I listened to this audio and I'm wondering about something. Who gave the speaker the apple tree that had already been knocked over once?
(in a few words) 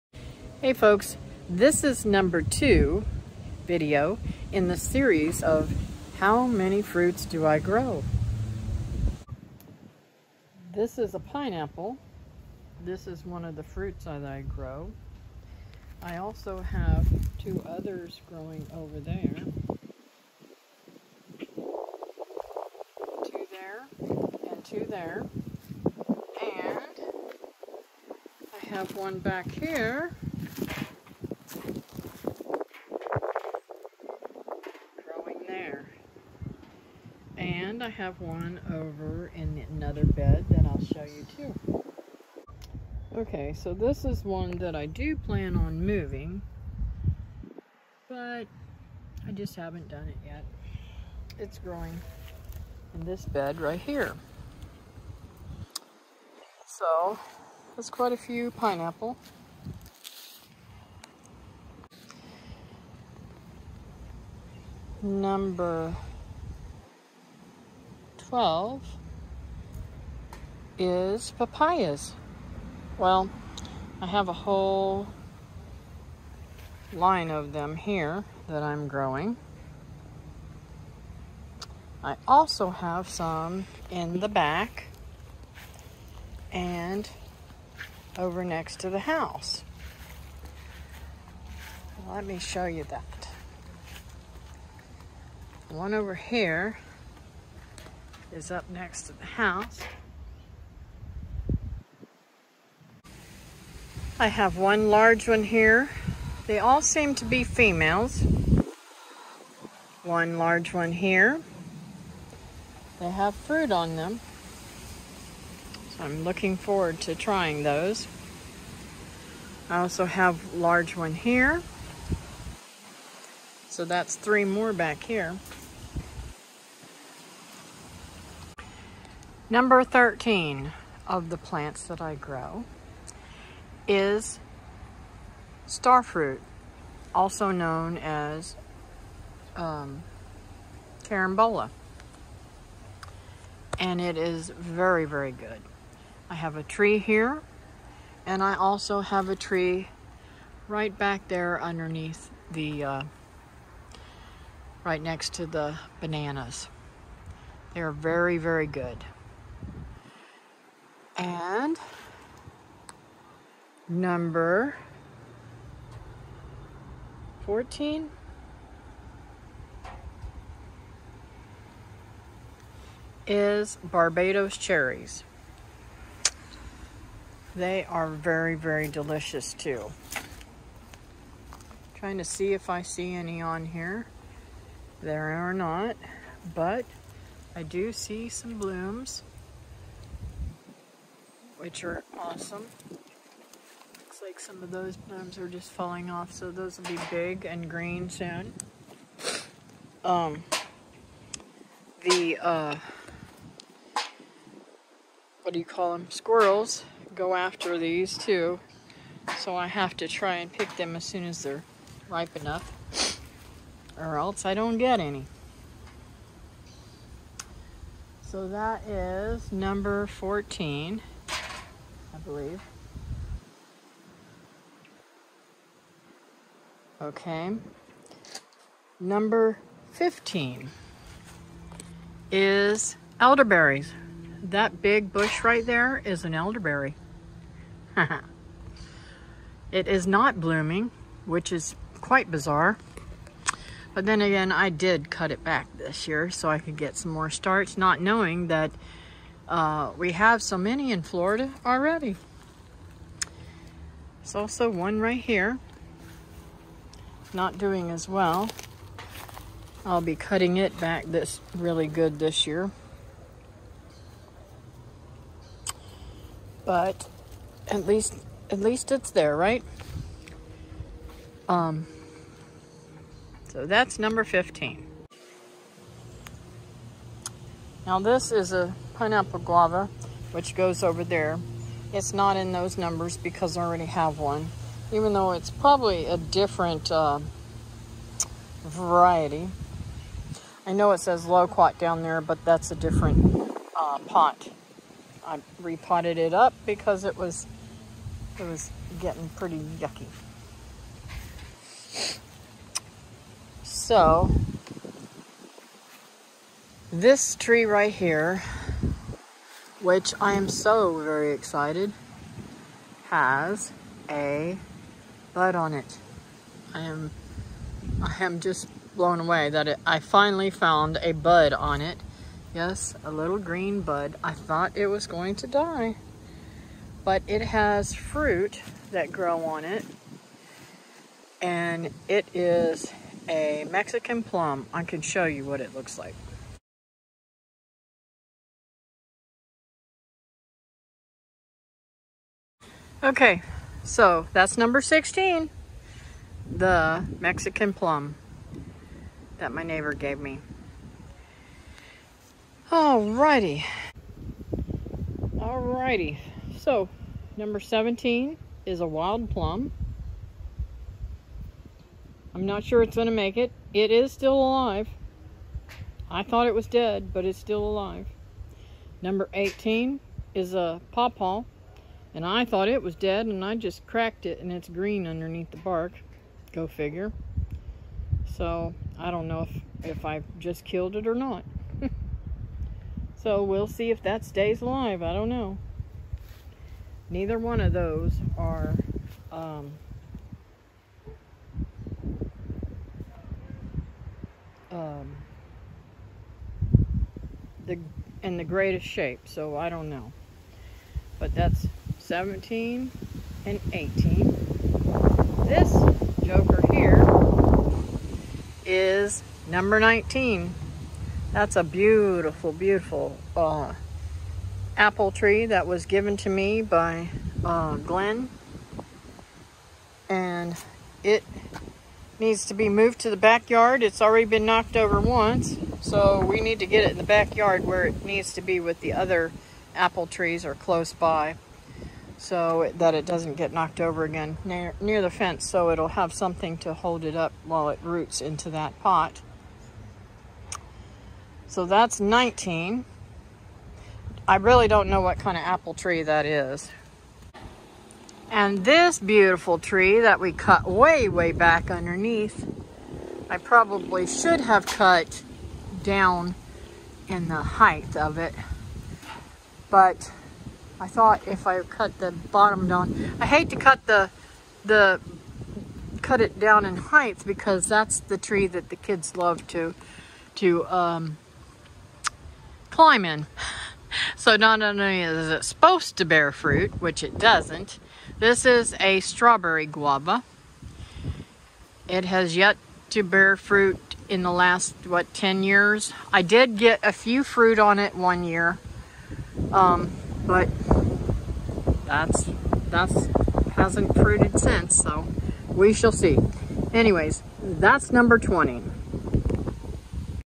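Glenn.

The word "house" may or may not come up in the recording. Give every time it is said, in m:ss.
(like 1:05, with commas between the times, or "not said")
1:28, 1:39.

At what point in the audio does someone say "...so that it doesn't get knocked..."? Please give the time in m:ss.
7:12.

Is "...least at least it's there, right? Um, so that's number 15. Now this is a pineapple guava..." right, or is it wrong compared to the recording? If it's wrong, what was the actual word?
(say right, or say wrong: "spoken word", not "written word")
right.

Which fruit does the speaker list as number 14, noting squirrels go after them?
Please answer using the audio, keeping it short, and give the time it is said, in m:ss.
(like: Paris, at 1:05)
Barbados cherries, at 2:53.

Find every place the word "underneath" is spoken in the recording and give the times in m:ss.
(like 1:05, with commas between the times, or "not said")
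2:31, 6:15, 7:31.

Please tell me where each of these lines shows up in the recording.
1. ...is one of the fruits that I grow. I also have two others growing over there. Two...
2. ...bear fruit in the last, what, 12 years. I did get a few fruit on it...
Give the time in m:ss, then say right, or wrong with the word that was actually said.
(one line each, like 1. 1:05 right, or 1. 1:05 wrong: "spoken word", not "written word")
1. 0:13 right
2. 8:03 wrong: "10", not "12".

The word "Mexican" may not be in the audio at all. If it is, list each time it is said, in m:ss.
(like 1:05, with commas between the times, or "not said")
5:33, 5:47.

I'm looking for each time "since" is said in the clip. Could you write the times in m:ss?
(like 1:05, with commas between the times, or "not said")
8:14.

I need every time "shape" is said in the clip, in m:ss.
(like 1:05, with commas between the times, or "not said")
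6:38.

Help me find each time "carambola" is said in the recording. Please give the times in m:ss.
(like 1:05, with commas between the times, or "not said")
2:21.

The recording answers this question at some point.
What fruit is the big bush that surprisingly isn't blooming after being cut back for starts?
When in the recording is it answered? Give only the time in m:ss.
3:53.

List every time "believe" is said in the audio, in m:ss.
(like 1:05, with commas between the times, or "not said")
3:42.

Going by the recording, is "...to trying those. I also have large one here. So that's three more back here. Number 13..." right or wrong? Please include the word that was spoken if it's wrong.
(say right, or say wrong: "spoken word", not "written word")
right.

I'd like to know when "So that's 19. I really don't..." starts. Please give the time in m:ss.
7:21.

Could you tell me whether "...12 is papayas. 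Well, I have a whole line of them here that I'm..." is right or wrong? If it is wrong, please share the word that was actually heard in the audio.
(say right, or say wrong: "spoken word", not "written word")
right.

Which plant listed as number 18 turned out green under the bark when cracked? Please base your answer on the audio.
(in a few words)
pawpaw.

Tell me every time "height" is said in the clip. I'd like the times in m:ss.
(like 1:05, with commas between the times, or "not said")
7:37, 7:46.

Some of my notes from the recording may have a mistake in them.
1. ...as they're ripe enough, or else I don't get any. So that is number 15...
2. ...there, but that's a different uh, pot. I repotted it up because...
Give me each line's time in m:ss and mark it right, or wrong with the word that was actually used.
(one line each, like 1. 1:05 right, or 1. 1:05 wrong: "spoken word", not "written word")
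1. 3:31 wrong: "14", not "15"
2. 4:52 right.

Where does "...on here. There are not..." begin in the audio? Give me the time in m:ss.
3:03.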